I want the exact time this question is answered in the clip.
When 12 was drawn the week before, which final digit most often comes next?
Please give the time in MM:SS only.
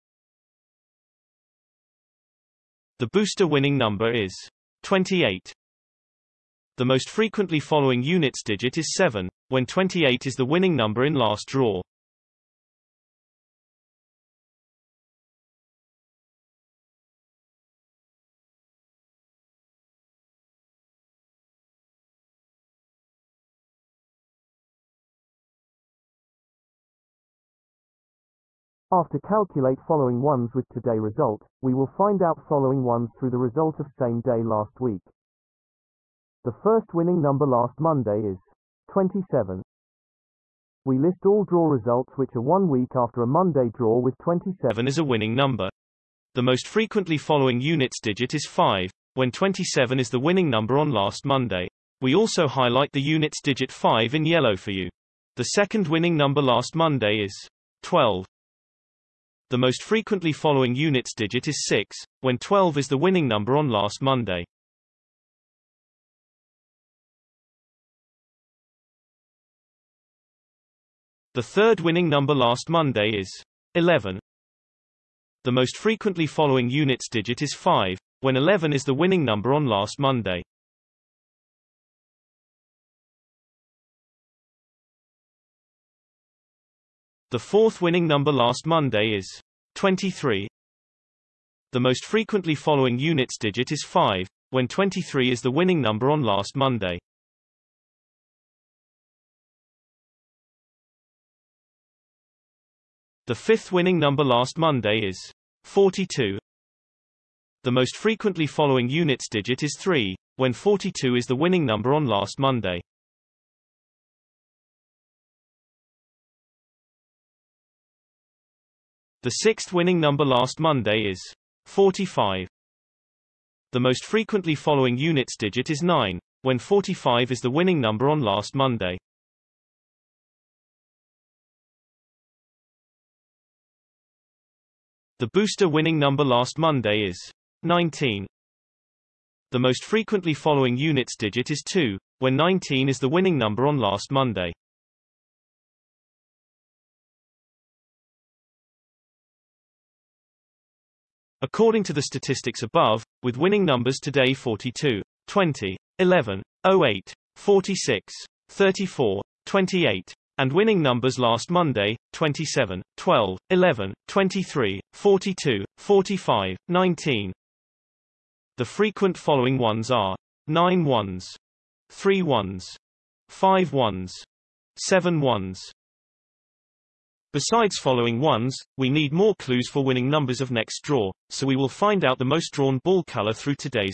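00:59.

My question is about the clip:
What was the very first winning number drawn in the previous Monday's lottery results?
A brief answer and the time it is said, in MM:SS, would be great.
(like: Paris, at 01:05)
27, at 00:36.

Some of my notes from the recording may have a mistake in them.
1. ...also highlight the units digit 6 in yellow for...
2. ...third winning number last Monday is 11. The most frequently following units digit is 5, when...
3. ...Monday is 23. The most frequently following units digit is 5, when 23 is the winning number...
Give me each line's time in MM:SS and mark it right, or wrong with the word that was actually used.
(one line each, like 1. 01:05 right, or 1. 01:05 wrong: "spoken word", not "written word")
1. 00:52 wrong: "5", not "6"
2. 01:11 right
3. 01:28 right.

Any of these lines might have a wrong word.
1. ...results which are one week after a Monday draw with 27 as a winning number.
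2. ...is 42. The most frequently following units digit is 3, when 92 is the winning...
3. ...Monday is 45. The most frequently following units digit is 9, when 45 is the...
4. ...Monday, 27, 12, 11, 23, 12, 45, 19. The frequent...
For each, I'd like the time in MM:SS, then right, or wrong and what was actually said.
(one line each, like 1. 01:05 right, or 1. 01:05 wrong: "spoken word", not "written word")
1. 00:41 right
2. 01:45 wrong: "42", not "92"
3. 02:00 right
4. 02:41 wrong: "42", not "12".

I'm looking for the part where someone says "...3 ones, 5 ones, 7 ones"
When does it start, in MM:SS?
02:51.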